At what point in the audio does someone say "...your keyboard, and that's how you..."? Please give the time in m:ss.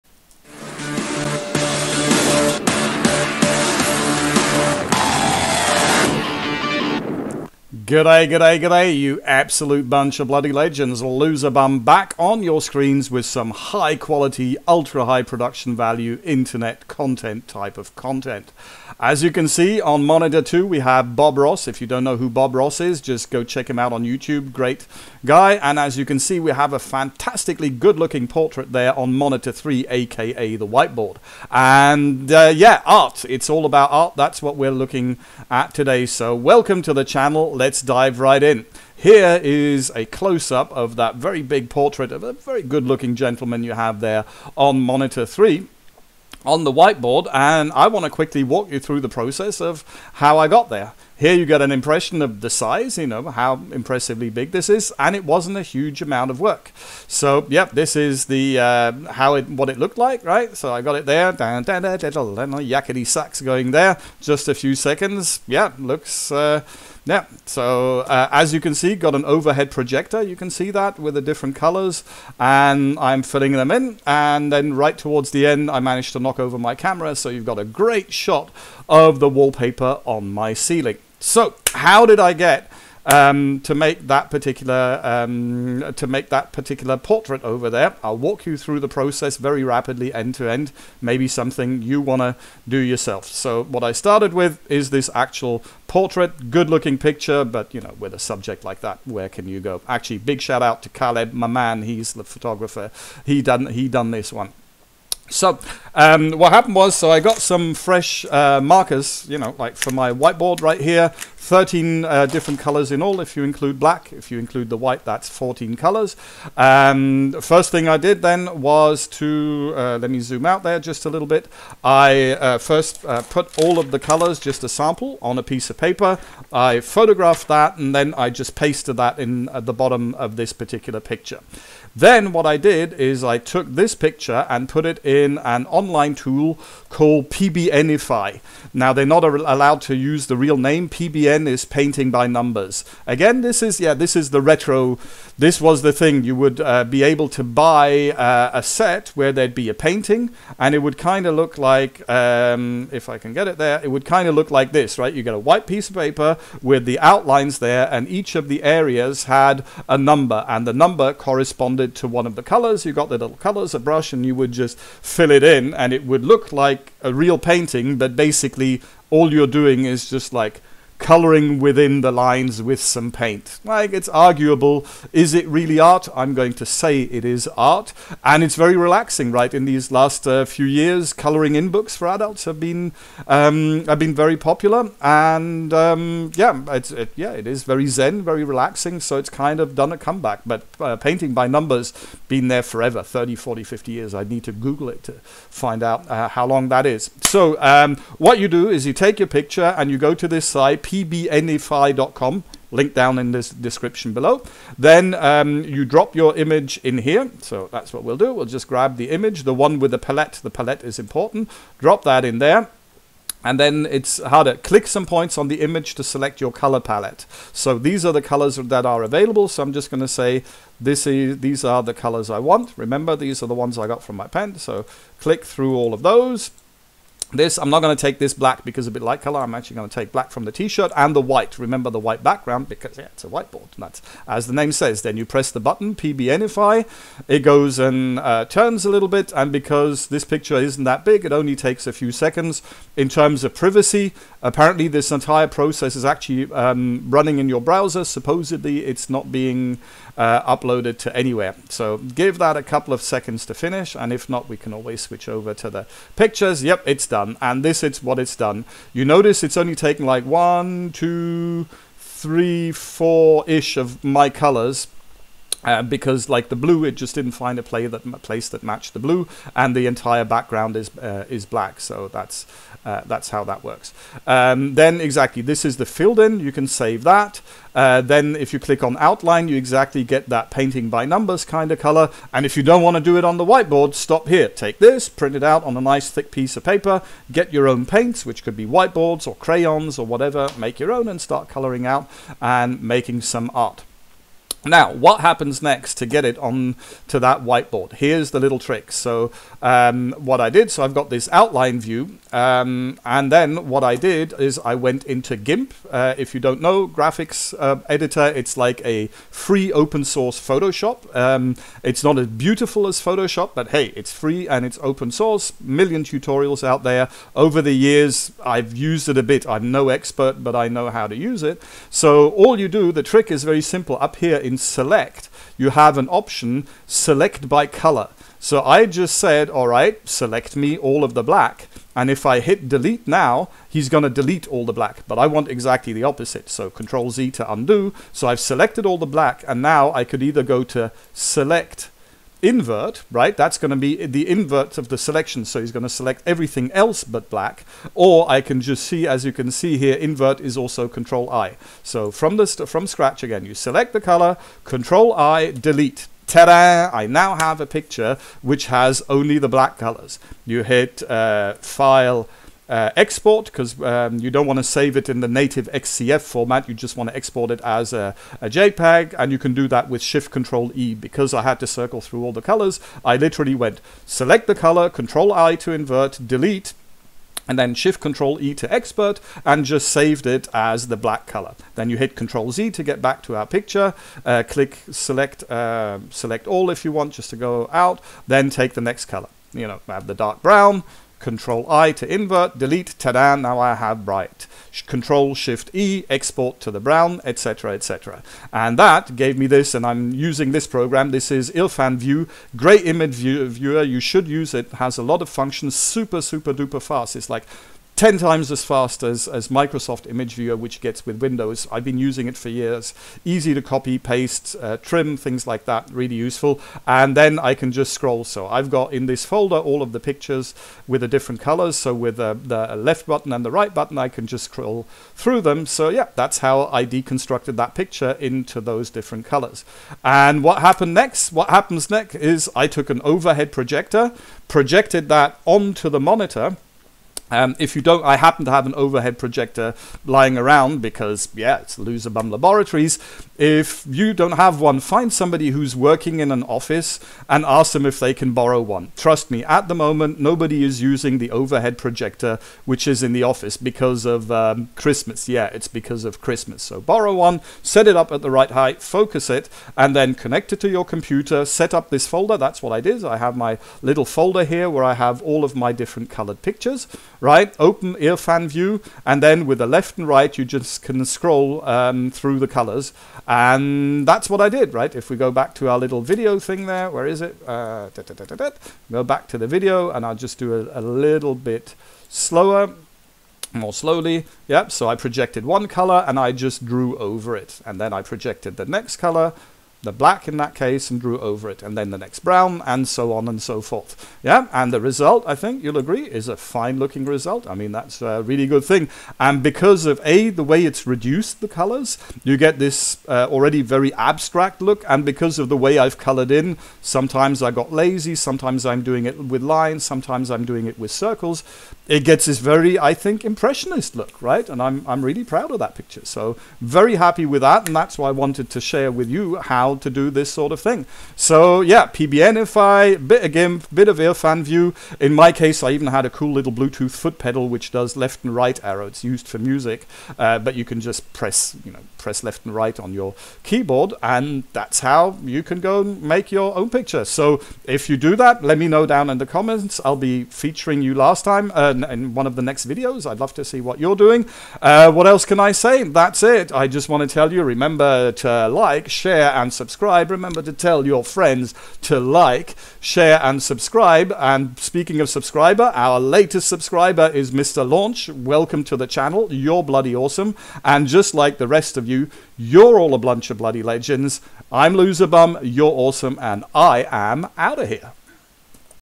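8:52.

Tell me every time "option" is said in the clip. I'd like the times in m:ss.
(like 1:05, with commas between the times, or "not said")
5:26.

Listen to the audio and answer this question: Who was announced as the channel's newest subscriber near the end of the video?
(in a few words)
Mr. Launch.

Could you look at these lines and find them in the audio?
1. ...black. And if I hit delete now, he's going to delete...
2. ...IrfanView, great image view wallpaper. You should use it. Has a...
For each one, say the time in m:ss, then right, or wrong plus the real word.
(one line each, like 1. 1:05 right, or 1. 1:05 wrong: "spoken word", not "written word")
1. 5:31 right
2. 6:41 wrong: "viewer", not "wallpaper".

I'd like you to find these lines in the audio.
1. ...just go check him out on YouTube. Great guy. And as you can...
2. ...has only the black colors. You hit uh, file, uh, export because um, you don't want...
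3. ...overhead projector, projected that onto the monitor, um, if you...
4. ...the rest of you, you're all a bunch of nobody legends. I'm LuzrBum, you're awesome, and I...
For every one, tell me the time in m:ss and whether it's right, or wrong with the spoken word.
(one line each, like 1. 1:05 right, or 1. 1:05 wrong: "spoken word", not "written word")
1. 0:23 right
2. 5:58 right
3. 7:13 right
4. 9:21 wrong: "bloody", not "nobody".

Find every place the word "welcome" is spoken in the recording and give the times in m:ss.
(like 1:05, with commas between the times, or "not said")
0:36, 9:18.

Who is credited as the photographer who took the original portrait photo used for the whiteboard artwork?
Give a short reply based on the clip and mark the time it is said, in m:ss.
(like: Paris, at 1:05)
Caleb, at 1:40.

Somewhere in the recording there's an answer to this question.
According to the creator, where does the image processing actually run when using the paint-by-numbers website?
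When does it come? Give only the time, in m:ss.
4:07.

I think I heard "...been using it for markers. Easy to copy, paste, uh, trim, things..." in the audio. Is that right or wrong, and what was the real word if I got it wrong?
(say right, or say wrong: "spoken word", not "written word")
wrong: "years", not "markers".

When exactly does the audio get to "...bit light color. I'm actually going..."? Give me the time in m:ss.
3:48.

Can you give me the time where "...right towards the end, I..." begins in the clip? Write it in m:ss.
1:14.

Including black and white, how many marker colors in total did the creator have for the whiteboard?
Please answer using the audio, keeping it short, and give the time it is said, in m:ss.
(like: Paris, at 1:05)
14, at 1:55.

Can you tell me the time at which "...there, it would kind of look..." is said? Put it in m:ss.
2:33.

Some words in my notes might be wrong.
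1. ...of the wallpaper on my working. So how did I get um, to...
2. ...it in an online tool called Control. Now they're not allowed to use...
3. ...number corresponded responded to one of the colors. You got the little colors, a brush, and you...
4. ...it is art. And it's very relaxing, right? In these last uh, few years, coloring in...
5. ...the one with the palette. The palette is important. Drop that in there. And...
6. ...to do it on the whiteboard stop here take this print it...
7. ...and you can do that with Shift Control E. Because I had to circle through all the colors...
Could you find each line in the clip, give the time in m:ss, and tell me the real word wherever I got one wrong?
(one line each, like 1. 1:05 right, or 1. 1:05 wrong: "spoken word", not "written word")
1. 1:18 wrong: "ceiling", not "working"
2. 2:14 wrong: "PBNify", not "Control"
3. 2:40 right
4. 2:57 right
5. 3:29 right
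6. 4:42 right
7. 6:09 right.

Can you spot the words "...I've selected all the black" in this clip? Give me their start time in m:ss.
5:38.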